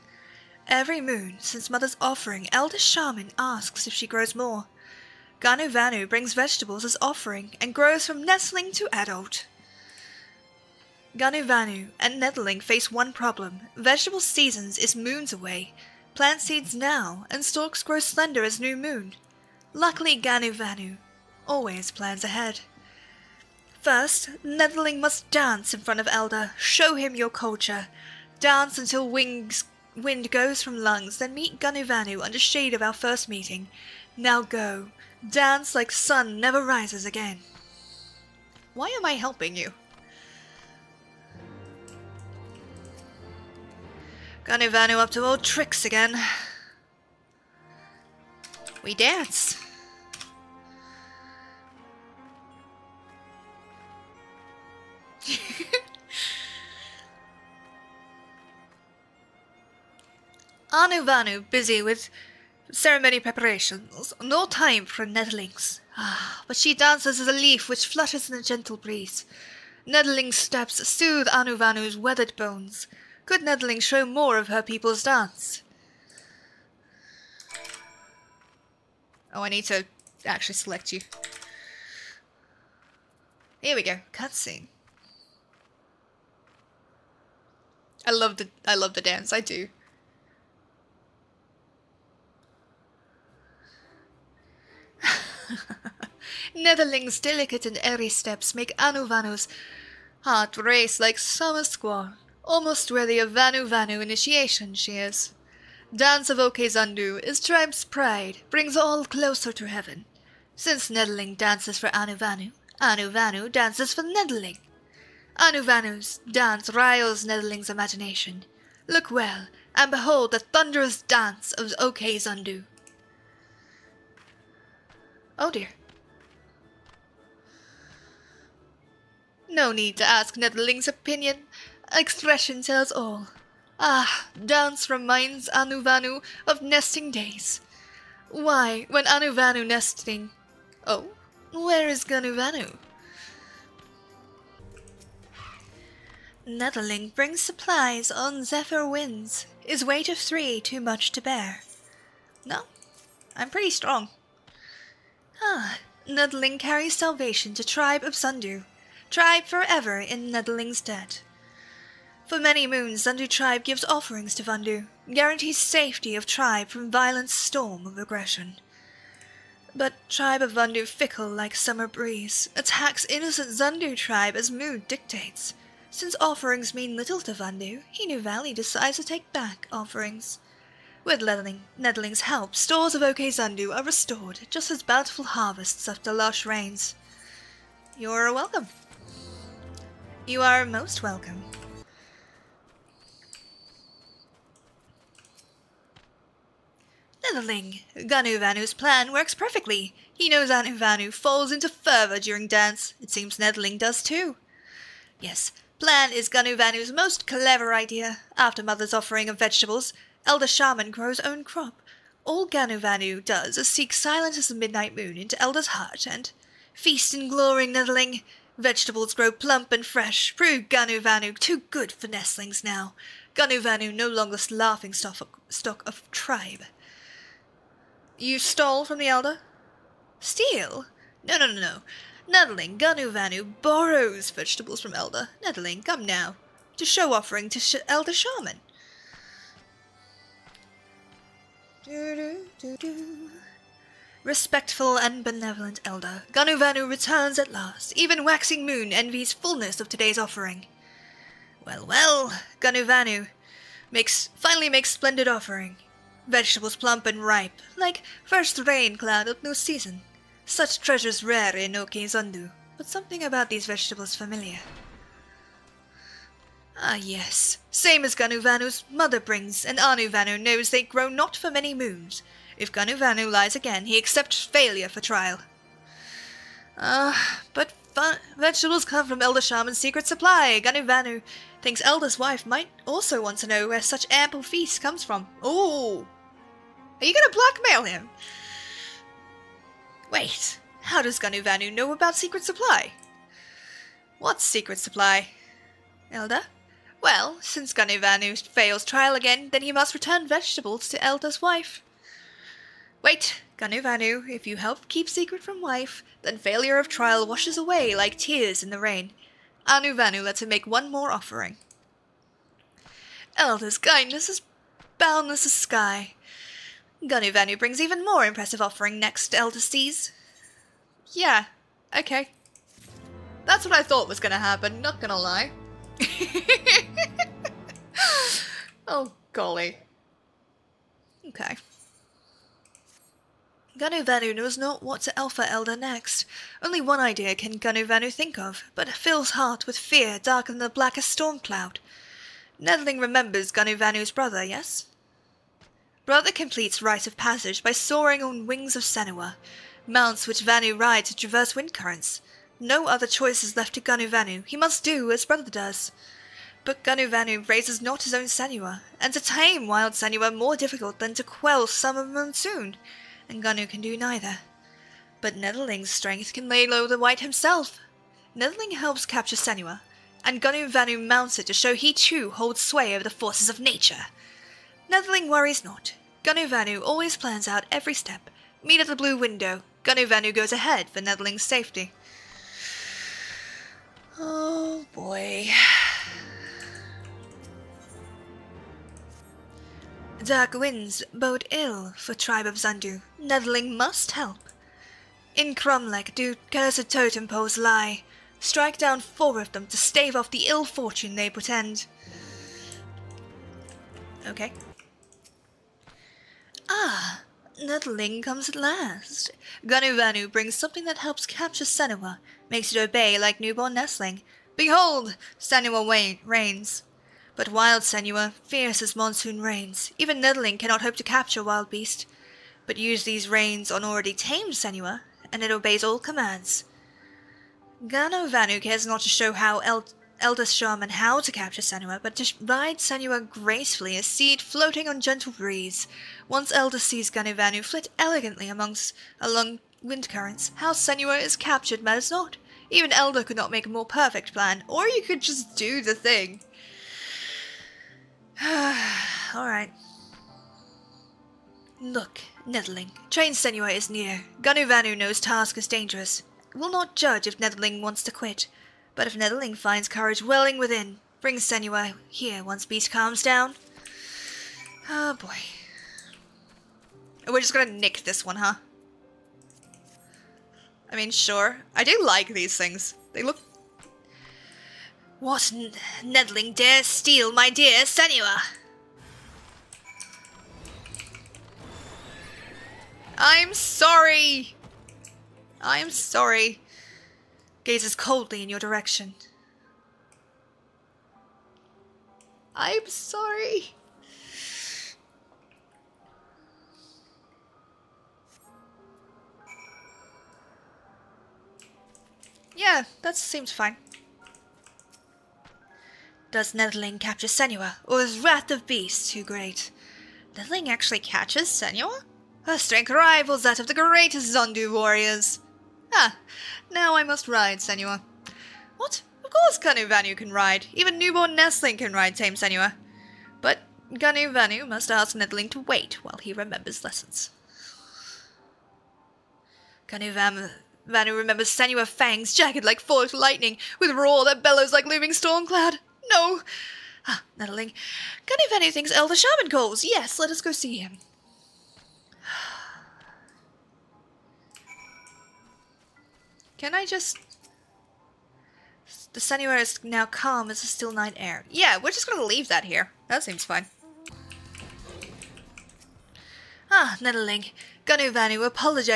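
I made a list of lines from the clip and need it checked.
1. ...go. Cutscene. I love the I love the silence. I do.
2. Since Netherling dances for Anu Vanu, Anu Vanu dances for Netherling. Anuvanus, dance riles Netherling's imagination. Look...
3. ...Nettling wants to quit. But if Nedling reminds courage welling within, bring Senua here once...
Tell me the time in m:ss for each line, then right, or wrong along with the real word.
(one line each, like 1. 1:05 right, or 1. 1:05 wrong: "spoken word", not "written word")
1. 1:23 wrong: "dance", not "silence"
2. 1:50 right
3. 7:37 wrong: "finds", not "reminds".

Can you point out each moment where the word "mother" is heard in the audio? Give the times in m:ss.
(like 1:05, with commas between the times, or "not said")
0:01, 3:28, 4:28.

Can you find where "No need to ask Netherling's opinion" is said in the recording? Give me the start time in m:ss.
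2:09.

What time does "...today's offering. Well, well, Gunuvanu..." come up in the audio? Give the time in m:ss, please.
4:09.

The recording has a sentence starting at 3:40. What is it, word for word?
Prove Ganuvanu too good for nestlings now.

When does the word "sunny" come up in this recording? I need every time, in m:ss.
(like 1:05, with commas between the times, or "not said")
9:09.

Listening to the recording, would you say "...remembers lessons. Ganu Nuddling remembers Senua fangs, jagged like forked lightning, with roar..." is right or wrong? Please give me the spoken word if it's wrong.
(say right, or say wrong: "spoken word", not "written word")
wrong: "Vanu", not "Nuddling".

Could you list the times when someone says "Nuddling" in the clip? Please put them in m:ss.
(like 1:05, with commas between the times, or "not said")
6:47, 7:00.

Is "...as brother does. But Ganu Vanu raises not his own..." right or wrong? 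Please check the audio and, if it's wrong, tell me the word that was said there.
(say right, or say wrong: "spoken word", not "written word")
right.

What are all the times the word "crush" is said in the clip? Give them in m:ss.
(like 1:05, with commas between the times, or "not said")
not said.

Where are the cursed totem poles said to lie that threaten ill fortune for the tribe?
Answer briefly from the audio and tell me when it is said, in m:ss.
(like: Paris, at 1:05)
Cromlech, at 6:35.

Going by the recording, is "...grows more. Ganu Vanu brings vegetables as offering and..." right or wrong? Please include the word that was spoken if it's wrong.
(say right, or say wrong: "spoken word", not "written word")
right.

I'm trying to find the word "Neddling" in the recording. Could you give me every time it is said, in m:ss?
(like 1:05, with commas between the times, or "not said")
2:26, 2:36.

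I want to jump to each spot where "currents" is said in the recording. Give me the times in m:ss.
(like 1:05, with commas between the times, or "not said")
5:51, 7:20.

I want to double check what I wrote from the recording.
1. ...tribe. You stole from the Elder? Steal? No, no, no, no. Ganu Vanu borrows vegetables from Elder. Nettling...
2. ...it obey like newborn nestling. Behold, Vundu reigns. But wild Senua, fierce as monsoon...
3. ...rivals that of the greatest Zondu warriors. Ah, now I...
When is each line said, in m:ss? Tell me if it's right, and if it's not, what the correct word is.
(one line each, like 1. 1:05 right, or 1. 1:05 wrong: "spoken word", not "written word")
1. 3:46 right
2. 6:52 wrong: "Senua", not "Vundu"
3. 8:32 right.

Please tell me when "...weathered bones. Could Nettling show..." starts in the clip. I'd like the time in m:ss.
1:11.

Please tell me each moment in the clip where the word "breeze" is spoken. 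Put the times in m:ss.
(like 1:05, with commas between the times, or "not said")
1:08, 2:51, 7:15.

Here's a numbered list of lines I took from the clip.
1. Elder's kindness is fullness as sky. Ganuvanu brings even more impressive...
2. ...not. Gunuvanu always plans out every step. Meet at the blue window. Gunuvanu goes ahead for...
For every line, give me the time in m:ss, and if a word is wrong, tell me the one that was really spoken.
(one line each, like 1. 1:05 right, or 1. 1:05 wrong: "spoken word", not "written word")
1. 5:13 wrong: "boundless", not "fullness"
2. 6:15 right.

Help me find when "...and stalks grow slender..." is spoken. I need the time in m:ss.
0:17.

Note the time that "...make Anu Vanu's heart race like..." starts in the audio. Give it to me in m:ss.
1:38.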